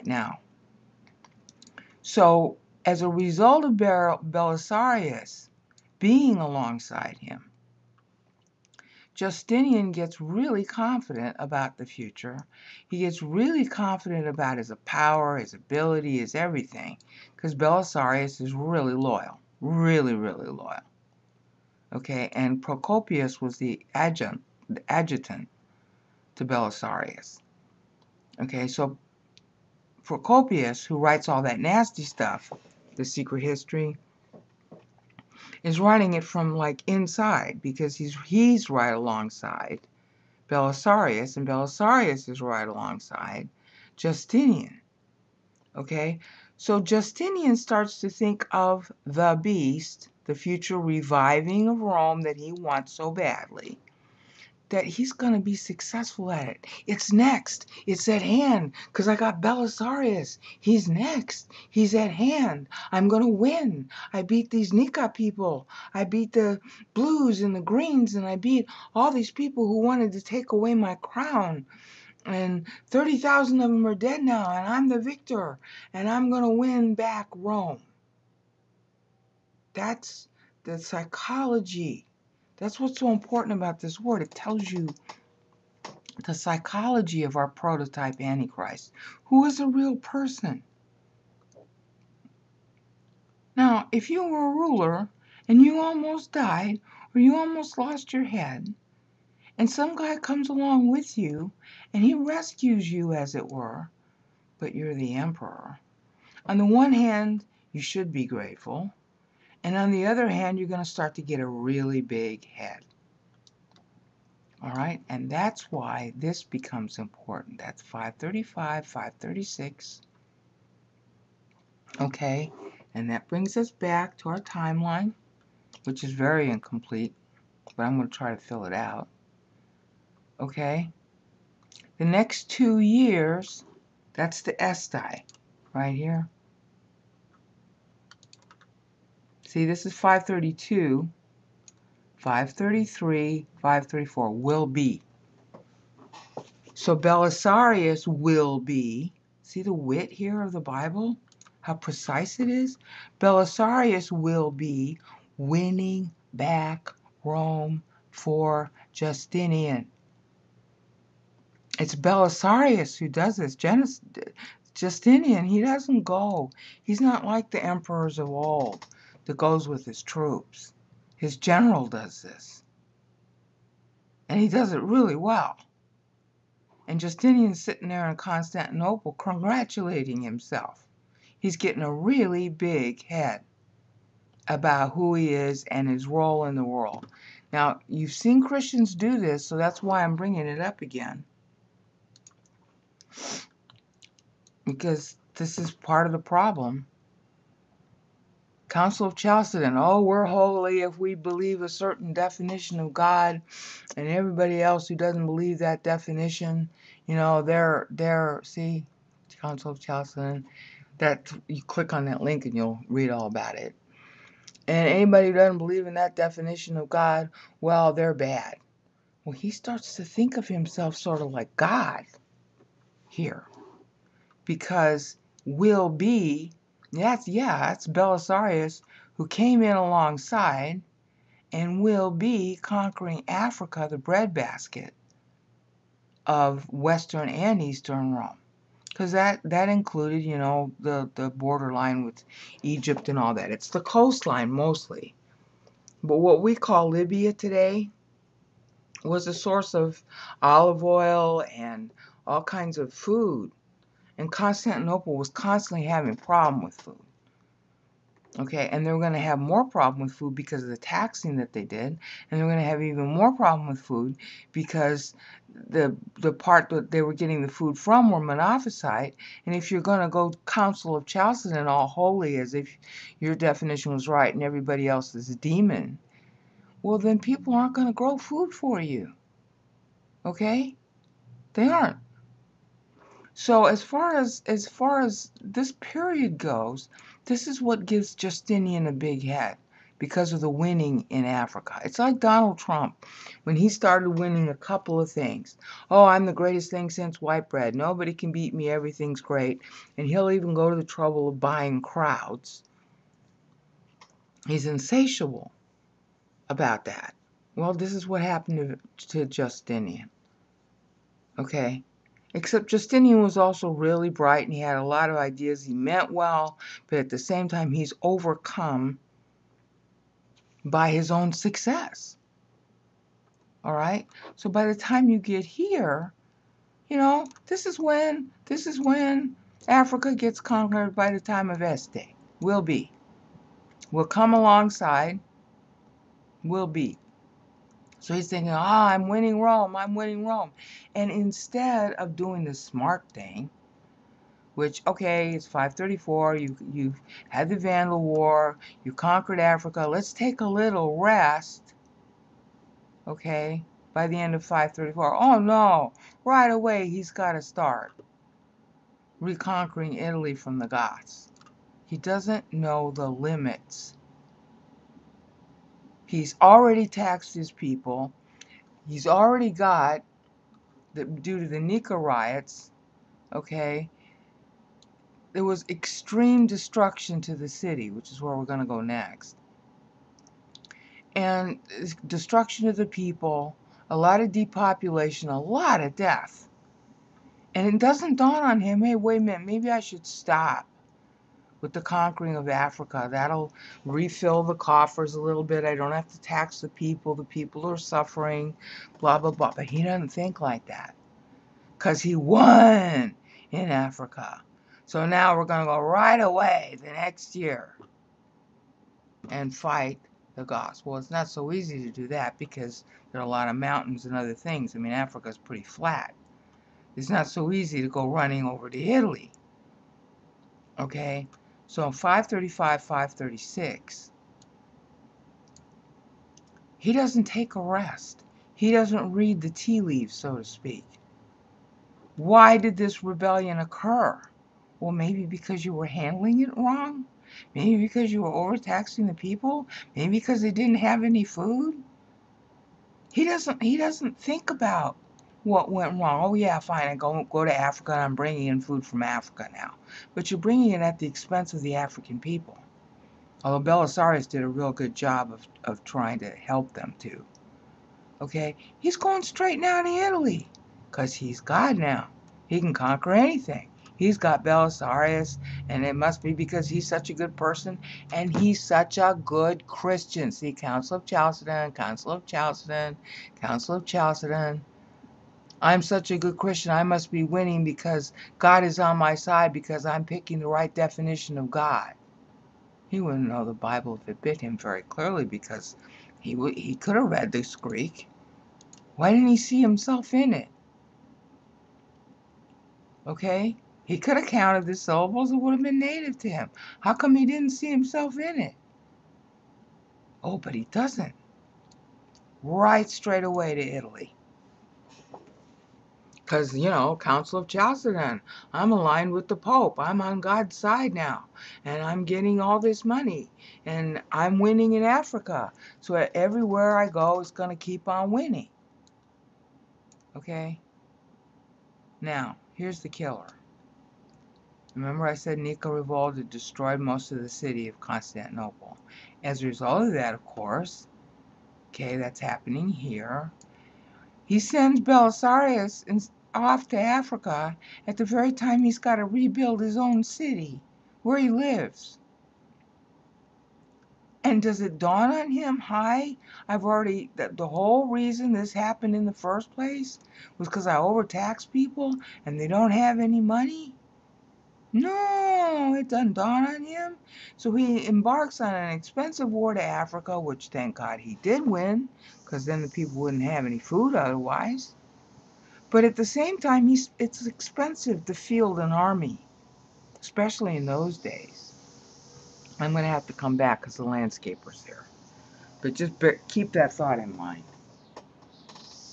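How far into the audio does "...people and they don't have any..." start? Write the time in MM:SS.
09:11.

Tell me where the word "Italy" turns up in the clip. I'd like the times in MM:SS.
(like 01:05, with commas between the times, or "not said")
05:59, 06:58, 07:39, 08:23.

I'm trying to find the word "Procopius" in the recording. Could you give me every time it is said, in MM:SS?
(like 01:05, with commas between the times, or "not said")
00:22, 00:30.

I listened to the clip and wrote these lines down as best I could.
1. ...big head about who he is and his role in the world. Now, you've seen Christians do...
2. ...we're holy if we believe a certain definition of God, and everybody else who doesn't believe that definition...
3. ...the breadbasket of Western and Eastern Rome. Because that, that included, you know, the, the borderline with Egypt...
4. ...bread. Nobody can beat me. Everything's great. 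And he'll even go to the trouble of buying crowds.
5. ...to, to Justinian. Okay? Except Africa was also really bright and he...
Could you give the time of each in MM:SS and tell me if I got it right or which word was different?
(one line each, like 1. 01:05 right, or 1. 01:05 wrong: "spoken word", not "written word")
1. 03:02 right
2. 03:20 right
3. 03:53 right
4. 04:57 right
5. 05:08 wrong: "Justinian", not "Africa".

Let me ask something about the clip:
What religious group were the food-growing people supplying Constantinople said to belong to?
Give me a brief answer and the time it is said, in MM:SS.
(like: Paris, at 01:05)
monophysite, at 04:28.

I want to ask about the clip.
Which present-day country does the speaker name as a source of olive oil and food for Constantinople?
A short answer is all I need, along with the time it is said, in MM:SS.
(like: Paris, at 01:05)
Libya, at 04:06.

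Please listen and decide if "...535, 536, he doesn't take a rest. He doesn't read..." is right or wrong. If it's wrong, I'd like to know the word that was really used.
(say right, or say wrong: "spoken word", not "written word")
right.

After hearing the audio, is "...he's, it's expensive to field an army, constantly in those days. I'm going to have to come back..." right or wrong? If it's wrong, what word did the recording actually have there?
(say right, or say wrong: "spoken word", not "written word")
wrong: "especially", not "constantly".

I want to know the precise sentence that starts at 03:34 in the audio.
And anybody who doesn't believe in that definition of God, well, they're bad.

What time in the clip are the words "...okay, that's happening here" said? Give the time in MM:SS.
08:51.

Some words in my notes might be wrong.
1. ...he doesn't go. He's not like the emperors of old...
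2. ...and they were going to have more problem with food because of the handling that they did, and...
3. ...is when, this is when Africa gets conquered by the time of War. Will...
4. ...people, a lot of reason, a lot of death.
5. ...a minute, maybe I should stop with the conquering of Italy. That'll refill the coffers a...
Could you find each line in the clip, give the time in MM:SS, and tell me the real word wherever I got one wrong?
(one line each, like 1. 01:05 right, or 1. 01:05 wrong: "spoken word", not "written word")
1. 02:45 right
2. 04:18 wrong: "taxing", not "handling"
3. 05:27 wrong: "Este", not "War"
4. 06:22 wrong: "depopulation", not "reason"
5. 06:29 wrong: "Africa", not "Italy".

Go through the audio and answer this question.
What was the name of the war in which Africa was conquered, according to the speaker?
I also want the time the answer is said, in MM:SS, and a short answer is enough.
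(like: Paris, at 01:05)
Vandal War, at 05:47.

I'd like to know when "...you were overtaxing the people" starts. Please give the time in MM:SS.
07:18.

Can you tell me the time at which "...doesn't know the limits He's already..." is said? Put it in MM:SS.
06:01.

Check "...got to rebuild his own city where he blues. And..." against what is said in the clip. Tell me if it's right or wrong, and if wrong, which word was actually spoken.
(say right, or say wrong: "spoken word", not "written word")
wrong: "lives", not "blues".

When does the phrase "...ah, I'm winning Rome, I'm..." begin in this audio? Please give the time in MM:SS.
05:38.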